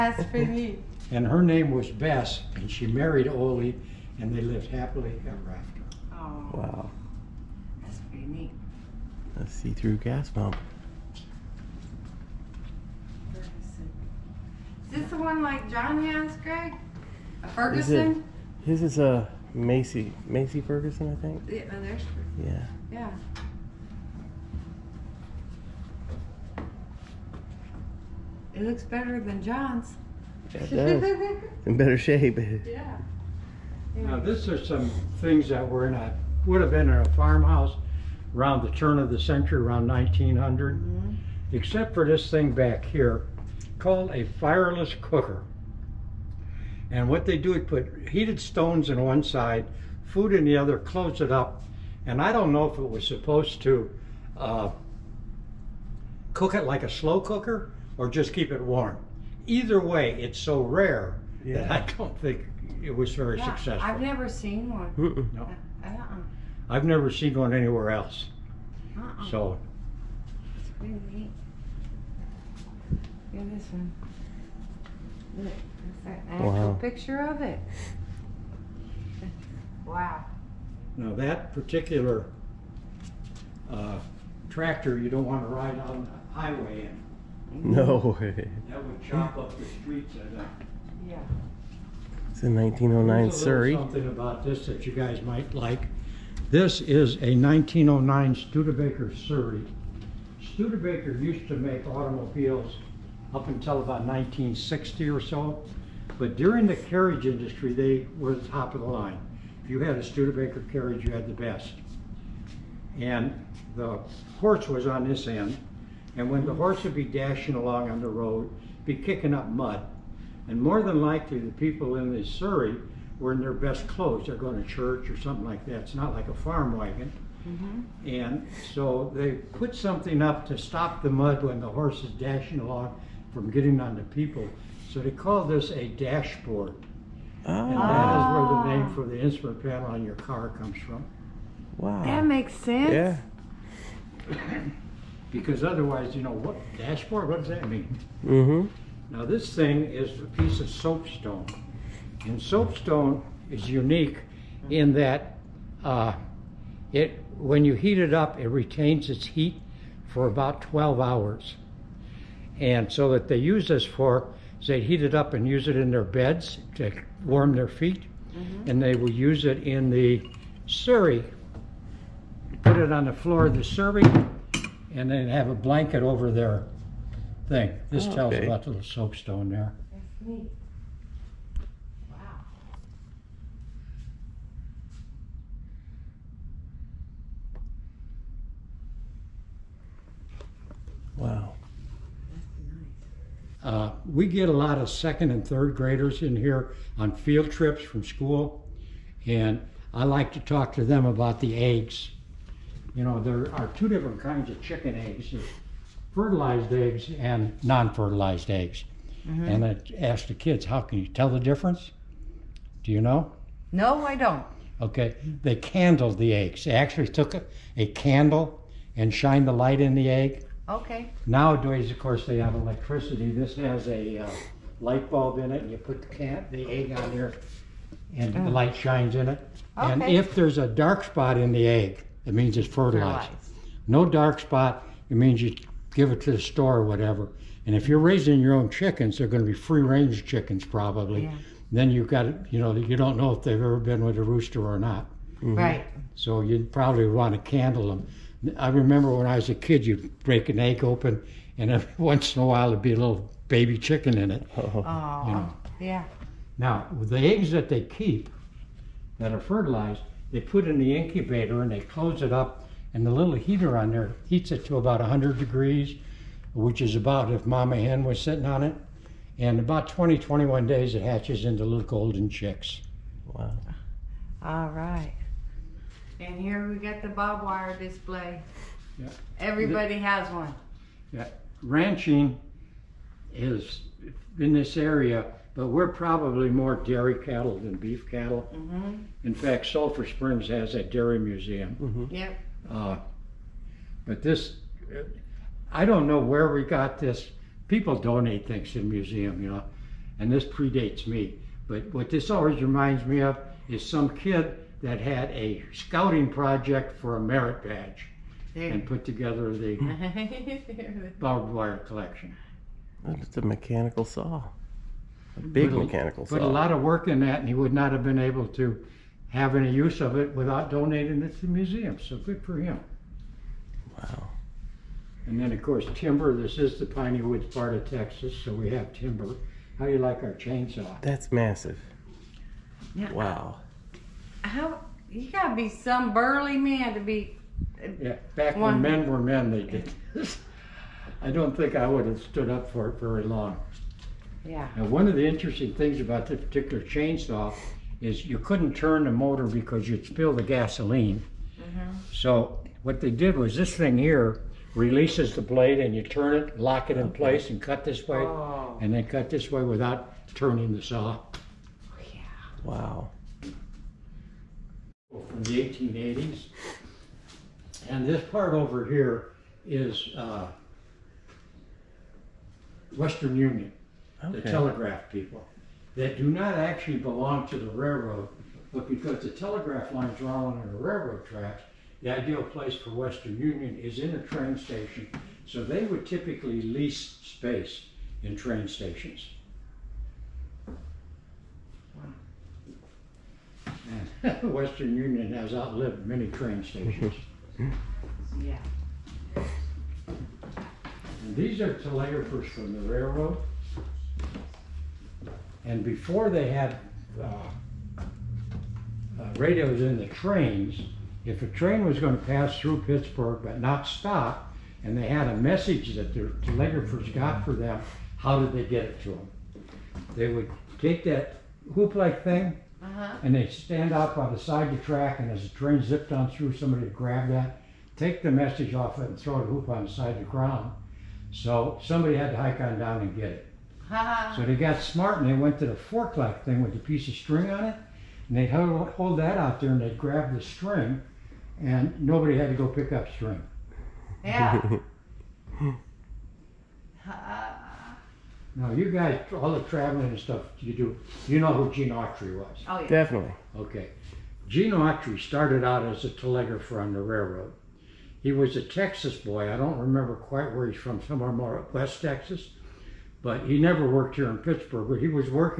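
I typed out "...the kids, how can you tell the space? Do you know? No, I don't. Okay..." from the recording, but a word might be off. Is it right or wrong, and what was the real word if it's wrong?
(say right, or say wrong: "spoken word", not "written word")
wrong: "difference", not "space".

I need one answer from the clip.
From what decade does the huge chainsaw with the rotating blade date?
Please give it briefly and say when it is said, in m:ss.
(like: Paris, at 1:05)
1880s, at 6:05.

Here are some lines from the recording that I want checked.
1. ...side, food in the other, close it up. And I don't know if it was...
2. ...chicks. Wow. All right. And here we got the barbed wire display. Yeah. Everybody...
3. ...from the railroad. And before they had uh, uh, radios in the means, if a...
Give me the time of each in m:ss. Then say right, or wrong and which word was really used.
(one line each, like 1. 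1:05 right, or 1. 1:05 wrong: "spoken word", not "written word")
1. 0:49 right
2. 4:32 right
3. 6:42 wrong: "trains", not "means".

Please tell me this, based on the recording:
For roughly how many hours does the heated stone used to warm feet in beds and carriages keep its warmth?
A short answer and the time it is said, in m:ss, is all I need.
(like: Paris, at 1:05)
12, at 2:40.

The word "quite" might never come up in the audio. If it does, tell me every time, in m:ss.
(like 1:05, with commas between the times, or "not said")
7:40.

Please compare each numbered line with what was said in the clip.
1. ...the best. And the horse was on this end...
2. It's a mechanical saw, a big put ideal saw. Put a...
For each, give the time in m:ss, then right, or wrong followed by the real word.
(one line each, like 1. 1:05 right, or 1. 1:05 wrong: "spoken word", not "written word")
1. 1:51 right
2. 5:13 wrong: "mechanical", not "ideal".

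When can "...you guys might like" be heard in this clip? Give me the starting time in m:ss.
1:34.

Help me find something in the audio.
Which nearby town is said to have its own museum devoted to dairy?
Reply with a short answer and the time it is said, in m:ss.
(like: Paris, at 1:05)
Sulphur Springs, at 4:49.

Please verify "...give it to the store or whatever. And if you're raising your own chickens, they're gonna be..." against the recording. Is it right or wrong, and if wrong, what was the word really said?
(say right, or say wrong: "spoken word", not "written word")
right.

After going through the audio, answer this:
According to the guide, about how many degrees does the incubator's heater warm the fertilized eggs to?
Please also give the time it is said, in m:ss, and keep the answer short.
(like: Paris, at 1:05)
100, at 4:24.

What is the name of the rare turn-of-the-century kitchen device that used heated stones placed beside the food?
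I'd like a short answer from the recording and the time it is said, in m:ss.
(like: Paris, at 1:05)
Fireless cooker, at 0:44.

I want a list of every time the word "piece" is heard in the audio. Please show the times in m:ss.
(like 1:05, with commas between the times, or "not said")
2:30, 7:16.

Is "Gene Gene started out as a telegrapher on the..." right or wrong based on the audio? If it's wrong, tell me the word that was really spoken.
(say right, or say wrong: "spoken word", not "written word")
wrong: "Autry", not "Gene".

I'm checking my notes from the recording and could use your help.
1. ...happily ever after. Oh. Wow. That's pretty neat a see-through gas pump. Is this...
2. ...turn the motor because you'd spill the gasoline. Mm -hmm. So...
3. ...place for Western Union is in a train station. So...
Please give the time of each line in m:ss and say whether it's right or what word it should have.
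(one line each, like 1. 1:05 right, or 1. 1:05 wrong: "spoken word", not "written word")
1. 0:04 right
2. 5:48 right
3. 6:22 right.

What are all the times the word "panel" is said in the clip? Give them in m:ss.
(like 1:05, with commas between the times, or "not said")
2:19.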